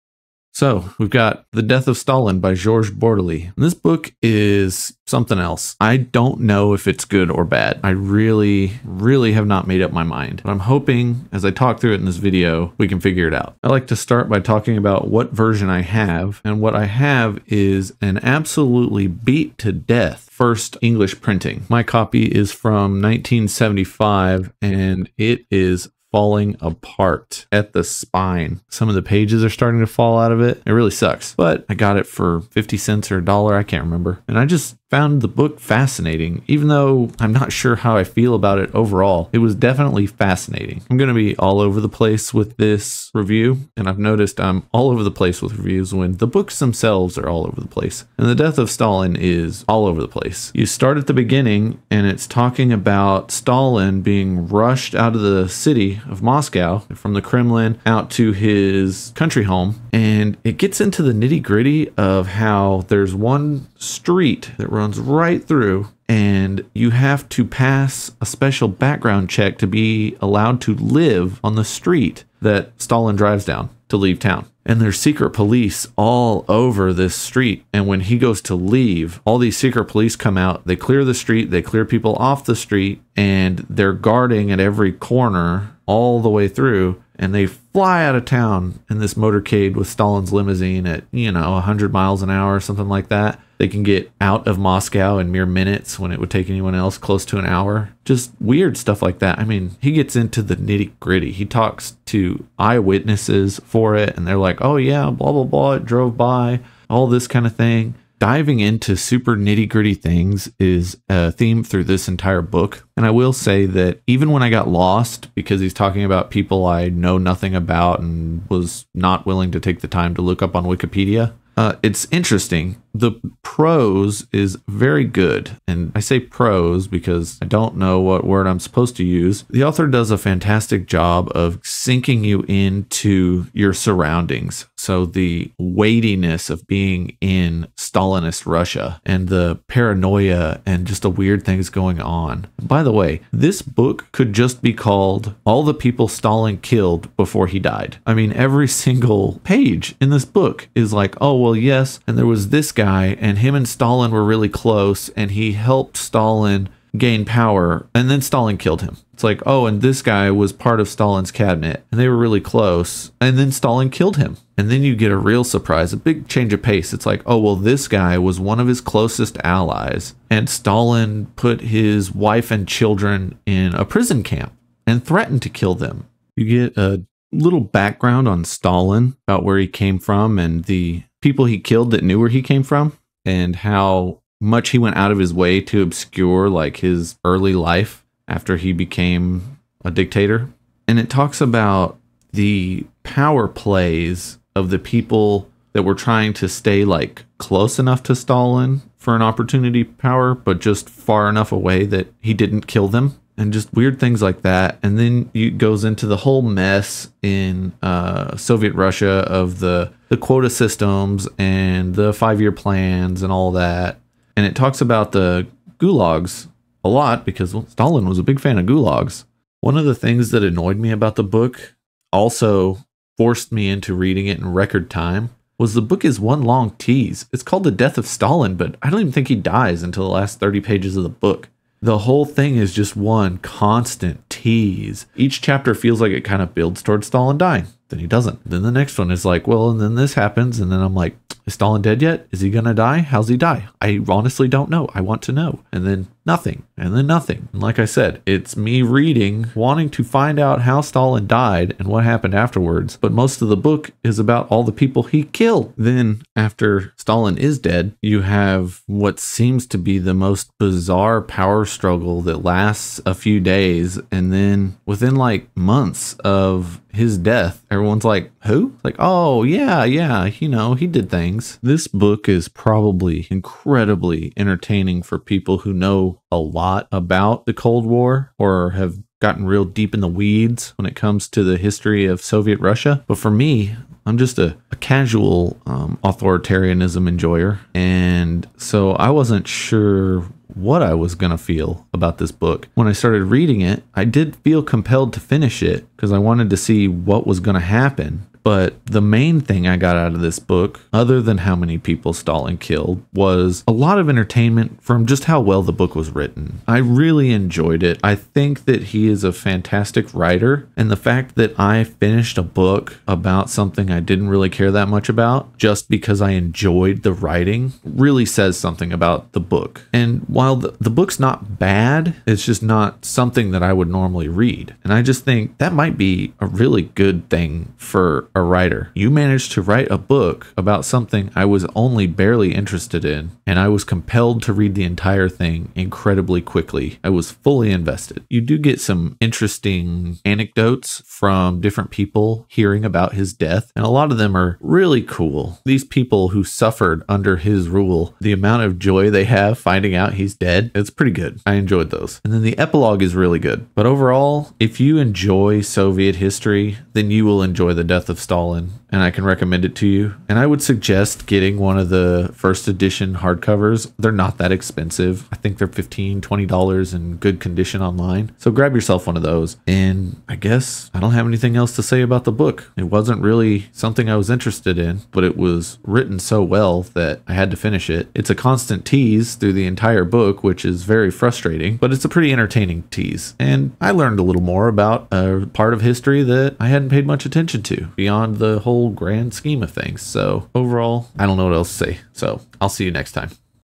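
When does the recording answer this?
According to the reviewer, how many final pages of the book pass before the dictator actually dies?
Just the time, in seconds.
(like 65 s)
230 s.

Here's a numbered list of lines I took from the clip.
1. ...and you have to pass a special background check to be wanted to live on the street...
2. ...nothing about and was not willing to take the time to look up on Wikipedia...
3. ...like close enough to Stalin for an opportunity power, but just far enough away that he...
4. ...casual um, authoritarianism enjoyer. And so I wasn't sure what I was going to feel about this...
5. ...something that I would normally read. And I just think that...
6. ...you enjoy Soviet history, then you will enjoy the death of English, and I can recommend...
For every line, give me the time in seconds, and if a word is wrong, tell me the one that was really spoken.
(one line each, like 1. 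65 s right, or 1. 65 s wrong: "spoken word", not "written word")
1. 66 s wrong: "allowed", not "wanted"
2. 117 s right
3. 196 s right
4. 284 s right
5. 323 s right
6. 354 s wrong: "Stalin", not "English".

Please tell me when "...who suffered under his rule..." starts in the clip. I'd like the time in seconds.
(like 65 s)
346 s.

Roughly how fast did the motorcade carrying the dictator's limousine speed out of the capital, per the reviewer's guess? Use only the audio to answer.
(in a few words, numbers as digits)
100 miles an hour.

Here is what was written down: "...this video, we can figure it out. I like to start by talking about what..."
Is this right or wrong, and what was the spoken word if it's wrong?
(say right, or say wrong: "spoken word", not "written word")
right.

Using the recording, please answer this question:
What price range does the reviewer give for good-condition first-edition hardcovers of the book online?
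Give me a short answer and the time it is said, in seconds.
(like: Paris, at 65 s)
$15 to $20, at 365 s.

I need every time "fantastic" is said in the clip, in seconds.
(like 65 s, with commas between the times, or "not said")
130 s, 309 s.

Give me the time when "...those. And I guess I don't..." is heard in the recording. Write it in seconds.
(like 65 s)
369 s.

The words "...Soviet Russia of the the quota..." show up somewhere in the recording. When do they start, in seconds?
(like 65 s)
208 s.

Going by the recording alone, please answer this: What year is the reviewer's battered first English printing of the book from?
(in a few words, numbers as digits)
1975.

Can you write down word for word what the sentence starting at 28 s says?
Some of the pages are starting to fall out of it.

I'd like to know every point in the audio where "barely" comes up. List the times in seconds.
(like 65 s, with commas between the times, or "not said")
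332 s.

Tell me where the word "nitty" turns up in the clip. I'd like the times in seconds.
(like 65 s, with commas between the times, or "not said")
61 s, 100 s, 109 s.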